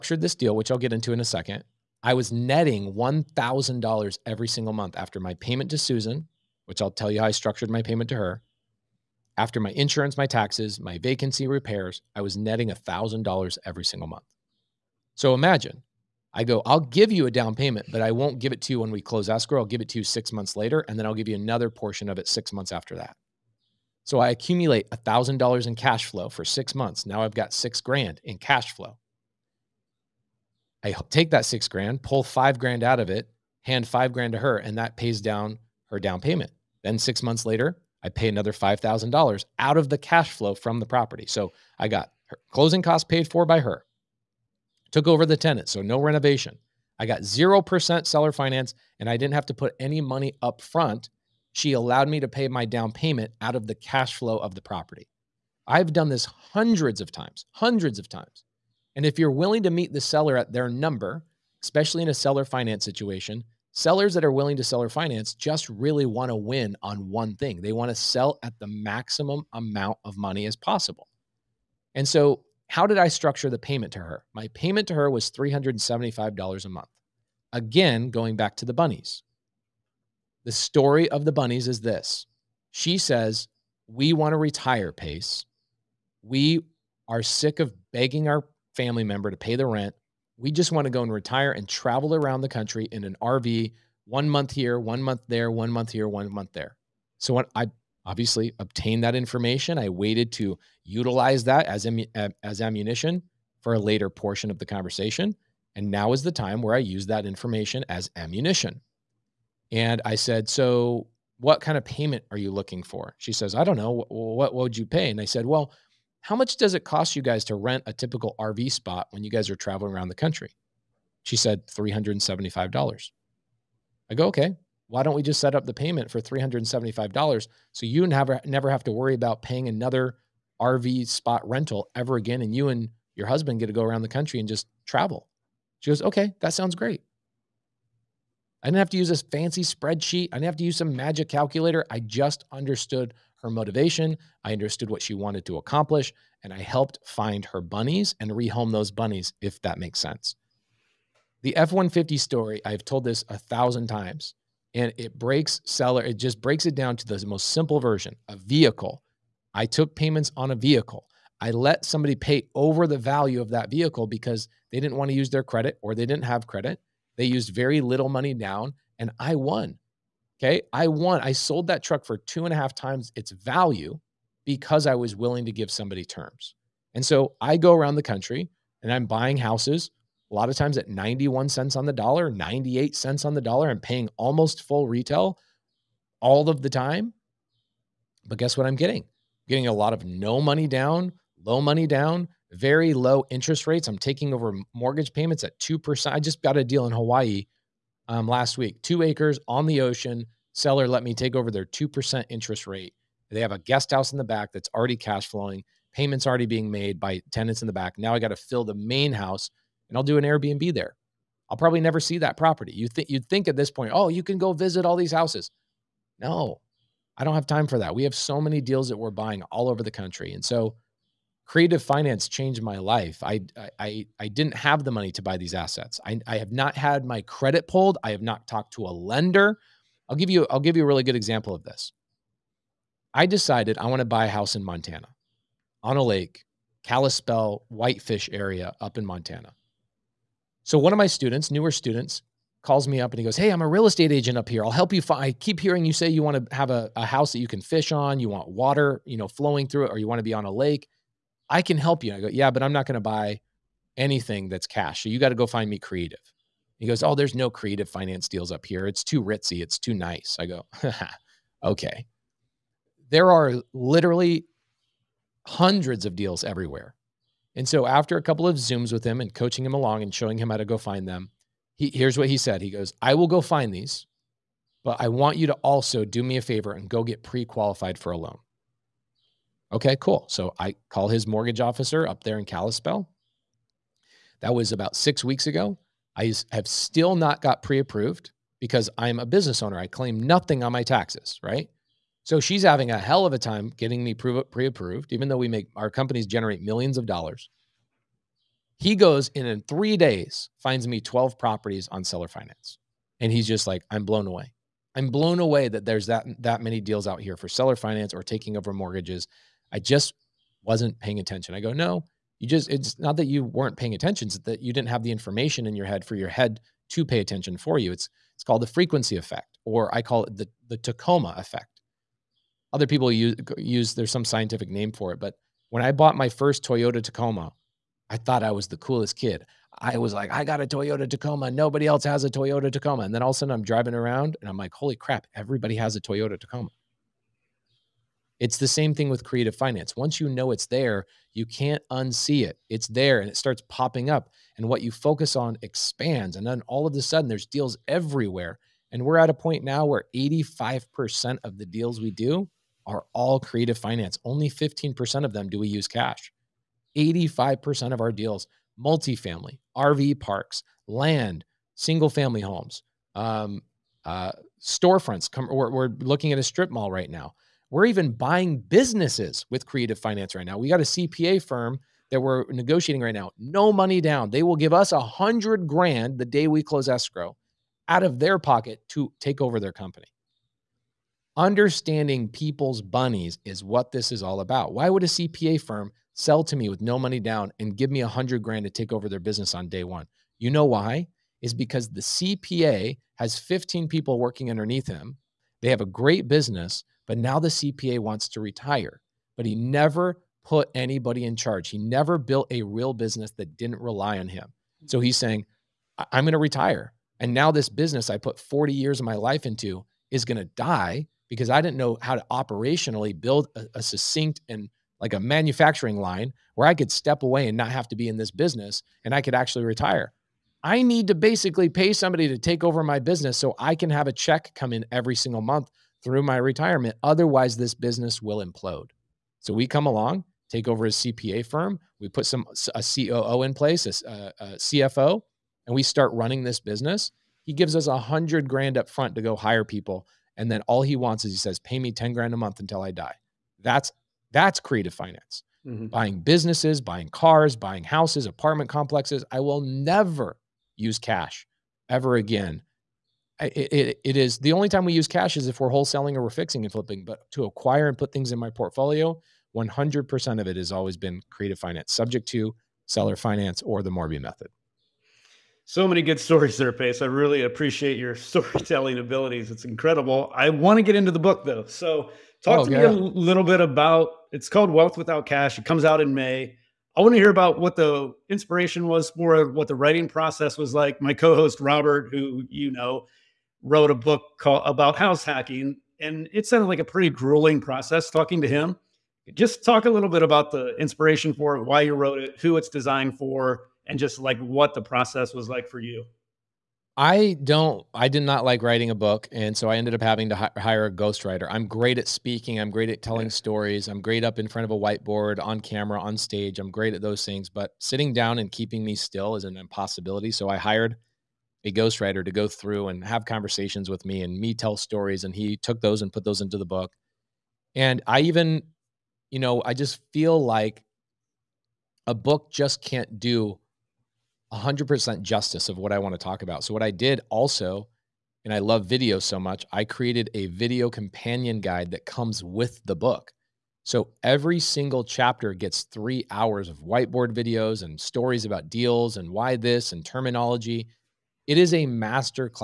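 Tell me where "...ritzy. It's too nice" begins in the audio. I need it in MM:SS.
04:19.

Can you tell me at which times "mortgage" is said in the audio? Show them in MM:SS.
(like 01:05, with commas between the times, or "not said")
03:14, 04:41, 05:08.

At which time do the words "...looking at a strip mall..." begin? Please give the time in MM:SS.
06:06.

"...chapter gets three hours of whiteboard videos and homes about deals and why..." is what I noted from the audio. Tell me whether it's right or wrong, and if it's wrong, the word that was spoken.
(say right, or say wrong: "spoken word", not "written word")
wrong: "stories", not "homes".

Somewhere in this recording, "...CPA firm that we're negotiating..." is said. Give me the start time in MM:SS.
06:10.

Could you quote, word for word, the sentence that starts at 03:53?
I decided I want to buy a house in Montana on a lake, Kalispell, Whitefish area up in Montana.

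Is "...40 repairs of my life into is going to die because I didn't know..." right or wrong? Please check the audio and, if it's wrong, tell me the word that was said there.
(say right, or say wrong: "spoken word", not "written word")
wrong: "years", not "repairs".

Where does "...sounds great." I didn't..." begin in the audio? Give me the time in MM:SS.
02:16.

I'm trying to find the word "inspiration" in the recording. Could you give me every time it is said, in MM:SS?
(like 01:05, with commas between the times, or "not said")
07:58, 08:10.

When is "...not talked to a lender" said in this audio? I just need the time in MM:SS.
03:48.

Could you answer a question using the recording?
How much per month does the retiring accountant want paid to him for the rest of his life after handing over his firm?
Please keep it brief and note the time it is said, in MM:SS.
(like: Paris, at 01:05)
10 grand, at 07:21.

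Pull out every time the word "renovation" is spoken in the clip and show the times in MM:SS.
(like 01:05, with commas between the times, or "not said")
00:45.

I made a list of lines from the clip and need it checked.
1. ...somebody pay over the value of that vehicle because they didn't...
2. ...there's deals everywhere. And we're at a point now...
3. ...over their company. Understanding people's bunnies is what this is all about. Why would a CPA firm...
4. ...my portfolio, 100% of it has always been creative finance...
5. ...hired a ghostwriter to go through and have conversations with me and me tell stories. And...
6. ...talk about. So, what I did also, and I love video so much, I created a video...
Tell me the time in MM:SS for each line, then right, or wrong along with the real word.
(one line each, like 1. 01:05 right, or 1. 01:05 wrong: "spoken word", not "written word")
1. 02:41 right
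2. 05:47 right
3. 06:19 right
4. 07:38 right
5. 08:30 right
6. 08:46 right.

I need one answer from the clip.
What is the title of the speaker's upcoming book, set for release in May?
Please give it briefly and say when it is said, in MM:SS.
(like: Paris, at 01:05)
Wealth Without Cash, at 07:54.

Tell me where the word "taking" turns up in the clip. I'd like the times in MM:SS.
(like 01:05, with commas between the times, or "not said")
03:13, 05:08.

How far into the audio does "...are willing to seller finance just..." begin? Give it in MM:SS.
01:04.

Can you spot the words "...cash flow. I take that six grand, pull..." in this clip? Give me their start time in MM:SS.
00:28.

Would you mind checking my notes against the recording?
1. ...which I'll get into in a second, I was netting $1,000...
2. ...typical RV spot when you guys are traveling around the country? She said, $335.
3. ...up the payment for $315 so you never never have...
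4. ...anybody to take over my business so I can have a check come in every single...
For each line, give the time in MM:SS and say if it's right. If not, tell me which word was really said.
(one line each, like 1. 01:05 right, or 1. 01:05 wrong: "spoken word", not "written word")
1. 00:00 right
2. 01:57 wrong: "375", not "335"
3. 02:05 wrong: "375", not "315"
4. 07:01 wrong: "somebody", not "anybody".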